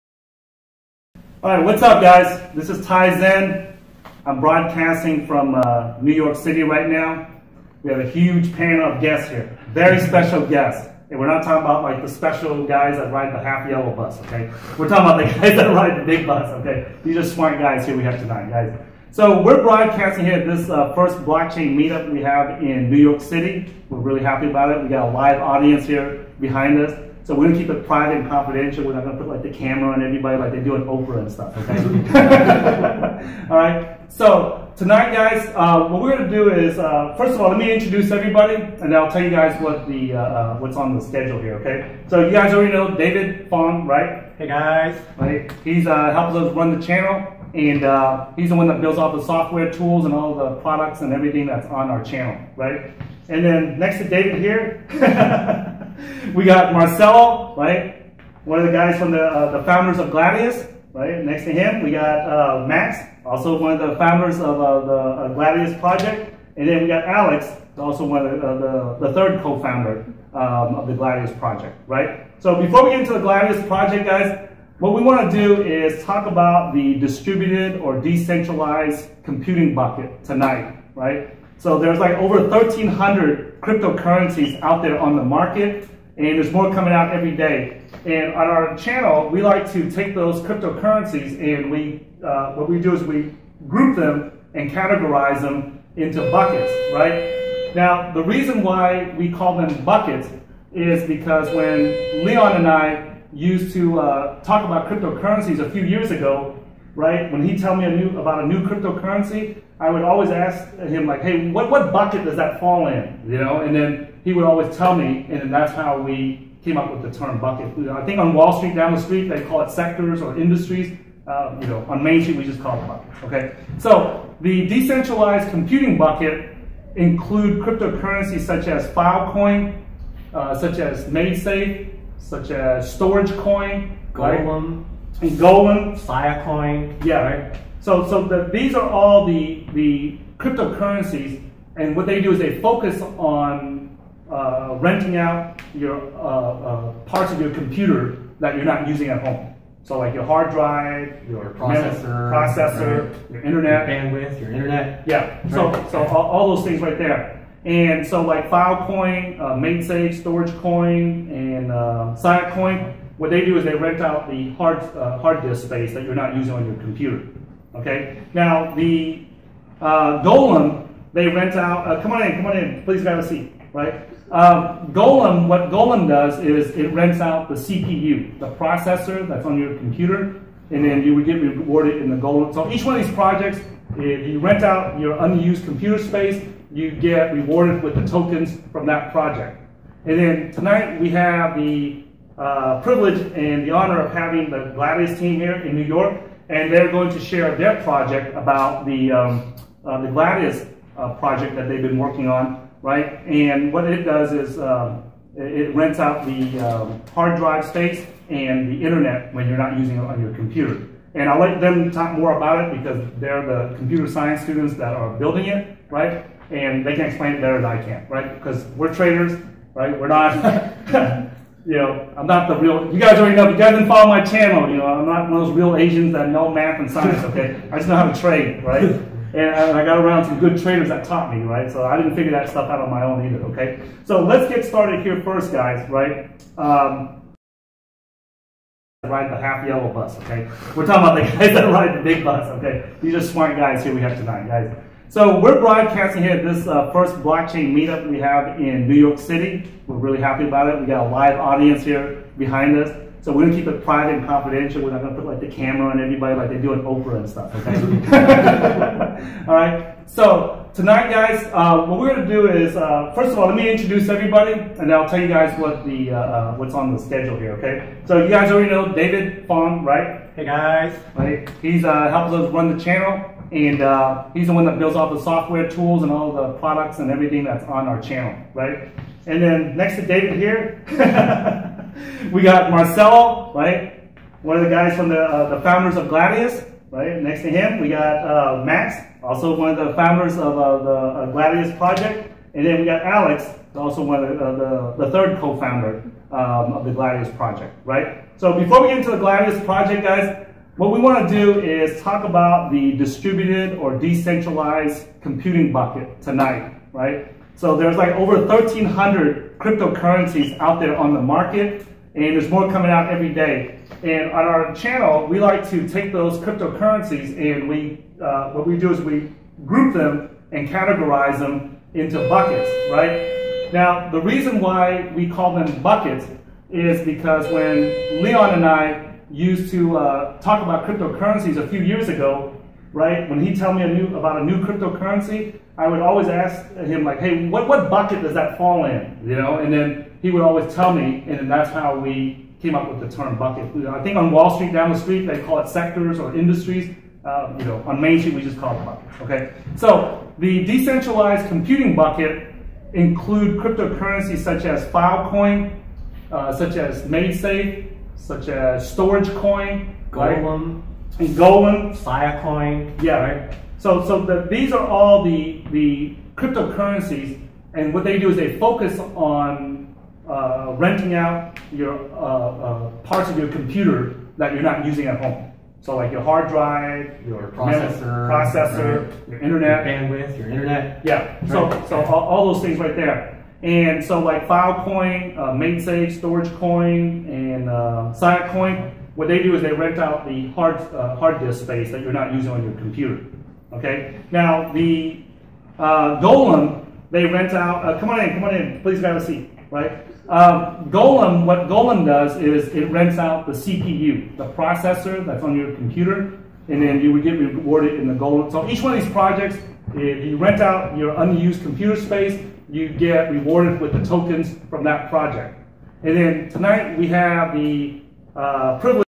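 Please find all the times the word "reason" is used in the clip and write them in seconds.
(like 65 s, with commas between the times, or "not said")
98 s, 324 s.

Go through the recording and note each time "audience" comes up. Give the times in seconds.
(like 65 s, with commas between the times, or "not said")
25 s, 251 s.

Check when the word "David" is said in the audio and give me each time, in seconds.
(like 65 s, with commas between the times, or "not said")
42 s, 54 s, 268 s, 280 s.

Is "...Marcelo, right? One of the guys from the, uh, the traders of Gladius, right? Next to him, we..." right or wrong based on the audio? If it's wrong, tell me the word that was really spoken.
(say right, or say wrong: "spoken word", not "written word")
wrong: "founders", not "traders".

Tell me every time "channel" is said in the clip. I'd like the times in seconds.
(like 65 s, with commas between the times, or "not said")
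46 s, 52 s, 88 s, 224 s, 272 s, 278 s, 314 s.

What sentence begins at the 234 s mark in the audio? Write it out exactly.
So let's get started here first, guys, right?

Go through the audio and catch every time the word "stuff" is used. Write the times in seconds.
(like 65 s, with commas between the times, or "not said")
31 s, 232 s, 257 s.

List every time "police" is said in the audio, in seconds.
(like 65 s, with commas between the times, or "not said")
not said.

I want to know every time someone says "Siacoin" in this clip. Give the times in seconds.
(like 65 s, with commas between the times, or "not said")
162 s, 388 s.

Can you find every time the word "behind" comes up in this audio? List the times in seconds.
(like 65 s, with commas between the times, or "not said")
26 s, 252 s.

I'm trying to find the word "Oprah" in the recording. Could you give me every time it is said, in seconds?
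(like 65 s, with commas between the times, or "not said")
30 s, 256 s.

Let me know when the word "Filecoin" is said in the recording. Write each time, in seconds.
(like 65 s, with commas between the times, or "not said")
128 s, 135 s, 158 s, 354 s, 384 s.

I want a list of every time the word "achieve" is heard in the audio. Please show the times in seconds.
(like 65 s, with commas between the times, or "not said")
not said.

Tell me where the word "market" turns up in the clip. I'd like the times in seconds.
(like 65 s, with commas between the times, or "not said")
85 s, 311 s.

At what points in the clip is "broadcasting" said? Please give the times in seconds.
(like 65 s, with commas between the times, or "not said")
4 s, 19 s, 245 s.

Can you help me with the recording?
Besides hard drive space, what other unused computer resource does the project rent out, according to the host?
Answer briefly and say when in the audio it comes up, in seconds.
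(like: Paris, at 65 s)
the internet, at 208 s.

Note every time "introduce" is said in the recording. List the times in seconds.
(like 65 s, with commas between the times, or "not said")
37 s, 263 s.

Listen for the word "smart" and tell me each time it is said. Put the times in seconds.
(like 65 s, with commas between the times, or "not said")
17 s, 243 s.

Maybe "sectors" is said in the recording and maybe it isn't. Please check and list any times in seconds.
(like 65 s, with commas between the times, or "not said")
119 s, 345 s.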